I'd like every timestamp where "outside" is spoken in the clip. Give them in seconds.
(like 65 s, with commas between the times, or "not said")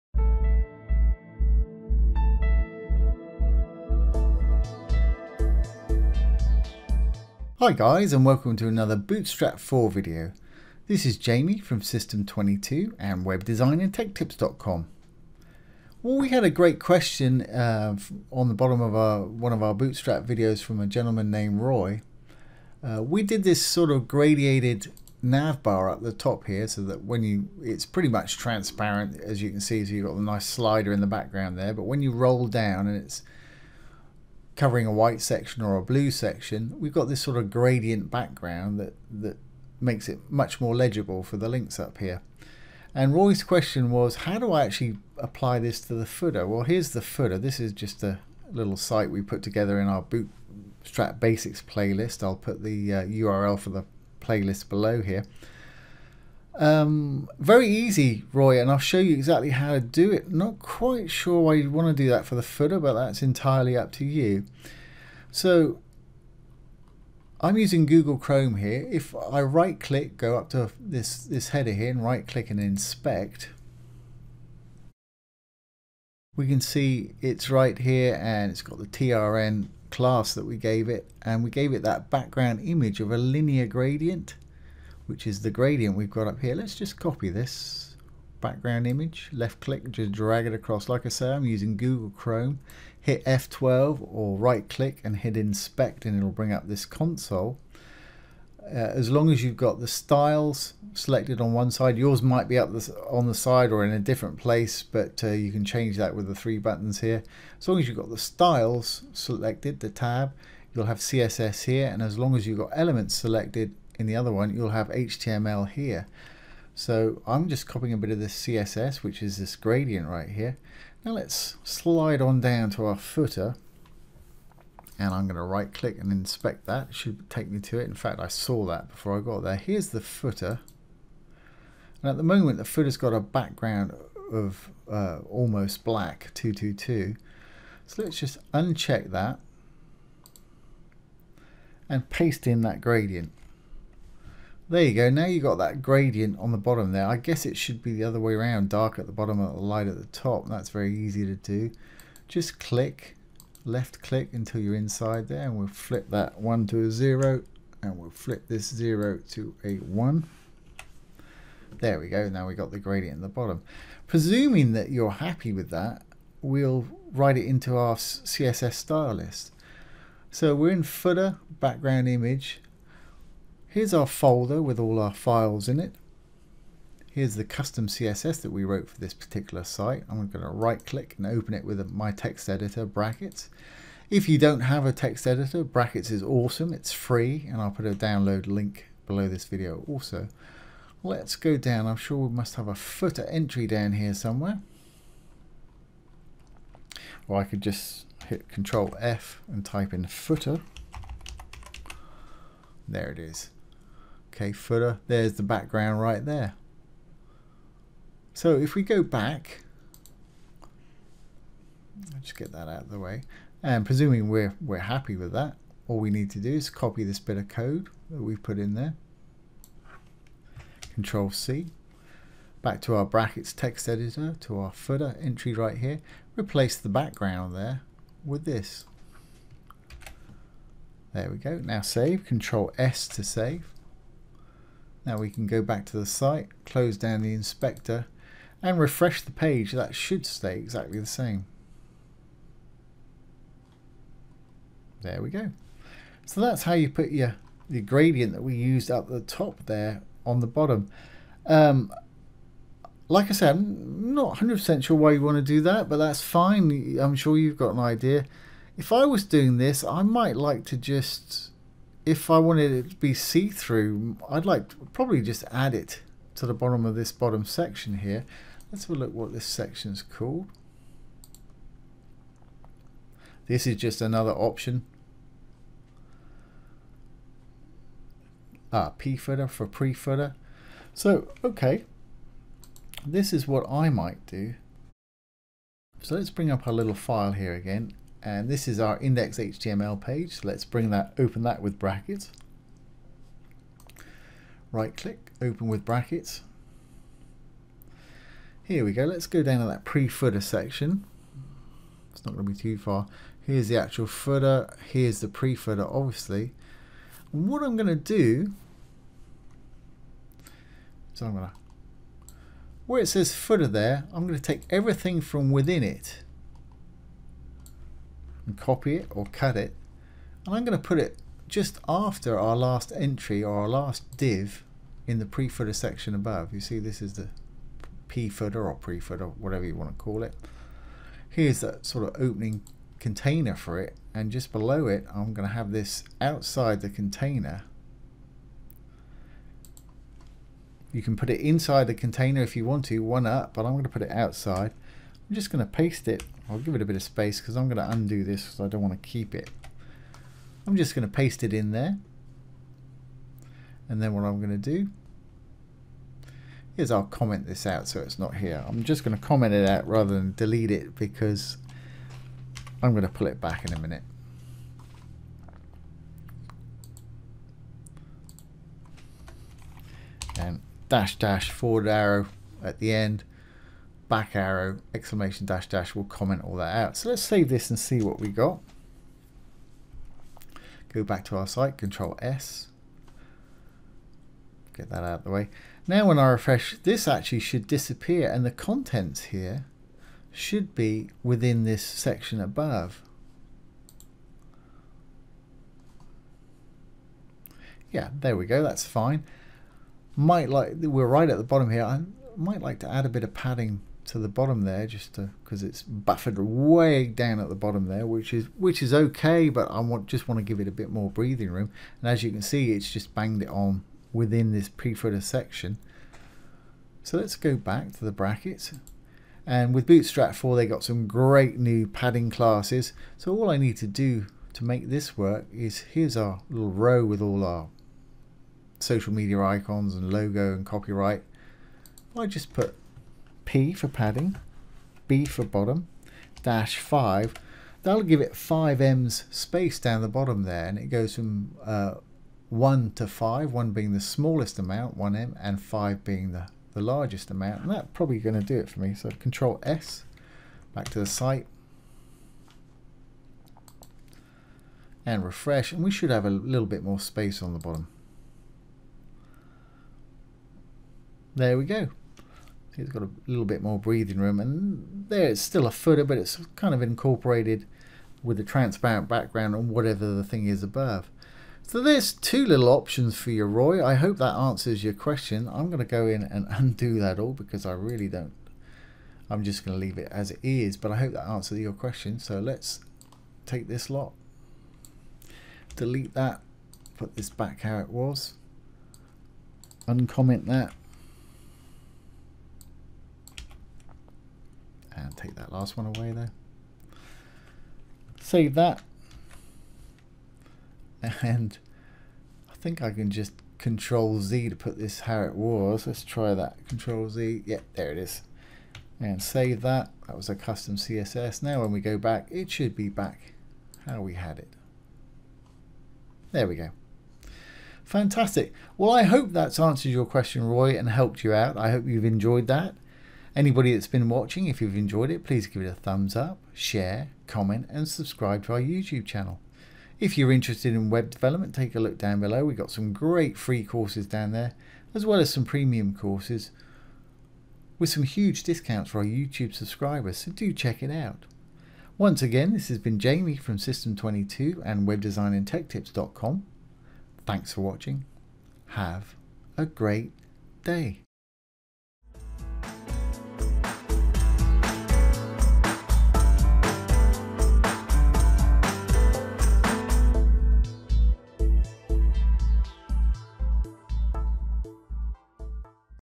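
336 s, 344 s.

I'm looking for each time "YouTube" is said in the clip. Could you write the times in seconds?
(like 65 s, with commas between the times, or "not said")
528 s, 539 s.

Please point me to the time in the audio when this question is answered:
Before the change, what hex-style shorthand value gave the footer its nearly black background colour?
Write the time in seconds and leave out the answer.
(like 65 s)
136 s.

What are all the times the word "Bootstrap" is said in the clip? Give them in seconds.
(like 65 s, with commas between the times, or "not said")
8 s, 19 s, 50 s, 419 s.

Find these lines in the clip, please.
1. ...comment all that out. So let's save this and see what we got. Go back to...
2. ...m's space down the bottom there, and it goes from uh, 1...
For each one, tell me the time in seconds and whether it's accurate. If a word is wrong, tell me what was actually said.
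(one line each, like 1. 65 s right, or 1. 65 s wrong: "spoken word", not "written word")
1. 376 s right
2. 438 s right.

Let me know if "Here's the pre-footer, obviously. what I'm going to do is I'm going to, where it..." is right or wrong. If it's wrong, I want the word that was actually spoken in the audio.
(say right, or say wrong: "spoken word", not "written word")
right.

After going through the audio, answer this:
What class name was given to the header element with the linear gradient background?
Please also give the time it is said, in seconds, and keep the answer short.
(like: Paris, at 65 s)
TRN, at 78 s.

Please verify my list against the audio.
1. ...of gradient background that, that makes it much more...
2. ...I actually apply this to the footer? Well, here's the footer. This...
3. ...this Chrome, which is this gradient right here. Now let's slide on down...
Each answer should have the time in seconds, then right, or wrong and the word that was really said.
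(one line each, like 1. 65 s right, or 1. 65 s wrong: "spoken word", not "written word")
1. 37 s right
2. 44 s right
3. 118 s wrong: "CSS", not "Chrome".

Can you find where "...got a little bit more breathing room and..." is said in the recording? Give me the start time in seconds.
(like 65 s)
462 s.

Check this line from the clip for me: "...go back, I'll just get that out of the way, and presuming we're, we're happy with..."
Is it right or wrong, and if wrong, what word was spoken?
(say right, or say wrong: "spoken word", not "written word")
right.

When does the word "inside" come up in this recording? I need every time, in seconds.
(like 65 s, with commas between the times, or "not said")
154 s, 341 s.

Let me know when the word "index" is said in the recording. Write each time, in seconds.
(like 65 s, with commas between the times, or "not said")
288 s.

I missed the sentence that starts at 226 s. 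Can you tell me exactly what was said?
Replace the background there with this.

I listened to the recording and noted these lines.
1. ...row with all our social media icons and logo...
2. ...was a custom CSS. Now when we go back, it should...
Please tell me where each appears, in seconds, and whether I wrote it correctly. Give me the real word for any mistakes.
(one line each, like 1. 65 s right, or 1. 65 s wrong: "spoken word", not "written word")
1. 426 s right
2. 510 s right.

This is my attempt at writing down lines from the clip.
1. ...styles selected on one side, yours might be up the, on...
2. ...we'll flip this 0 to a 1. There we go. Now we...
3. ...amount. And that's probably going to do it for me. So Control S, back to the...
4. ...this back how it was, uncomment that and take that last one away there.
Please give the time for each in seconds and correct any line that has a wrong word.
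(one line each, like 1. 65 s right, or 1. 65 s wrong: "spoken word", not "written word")
1. 99 s right
2. 157 s right
3. 447 s right
4. 487 s right.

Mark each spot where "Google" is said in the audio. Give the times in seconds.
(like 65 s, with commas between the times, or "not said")
67 s, 91 s.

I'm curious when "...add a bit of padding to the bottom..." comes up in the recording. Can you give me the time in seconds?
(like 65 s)
402 s.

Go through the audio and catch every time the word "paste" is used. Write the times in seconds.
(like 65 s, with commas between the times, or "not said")
142 s, 345 s, 351 s.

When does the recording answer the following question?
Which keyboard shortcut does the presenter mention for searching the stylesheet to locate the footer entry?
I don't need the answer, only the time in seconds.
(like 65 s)
198 s.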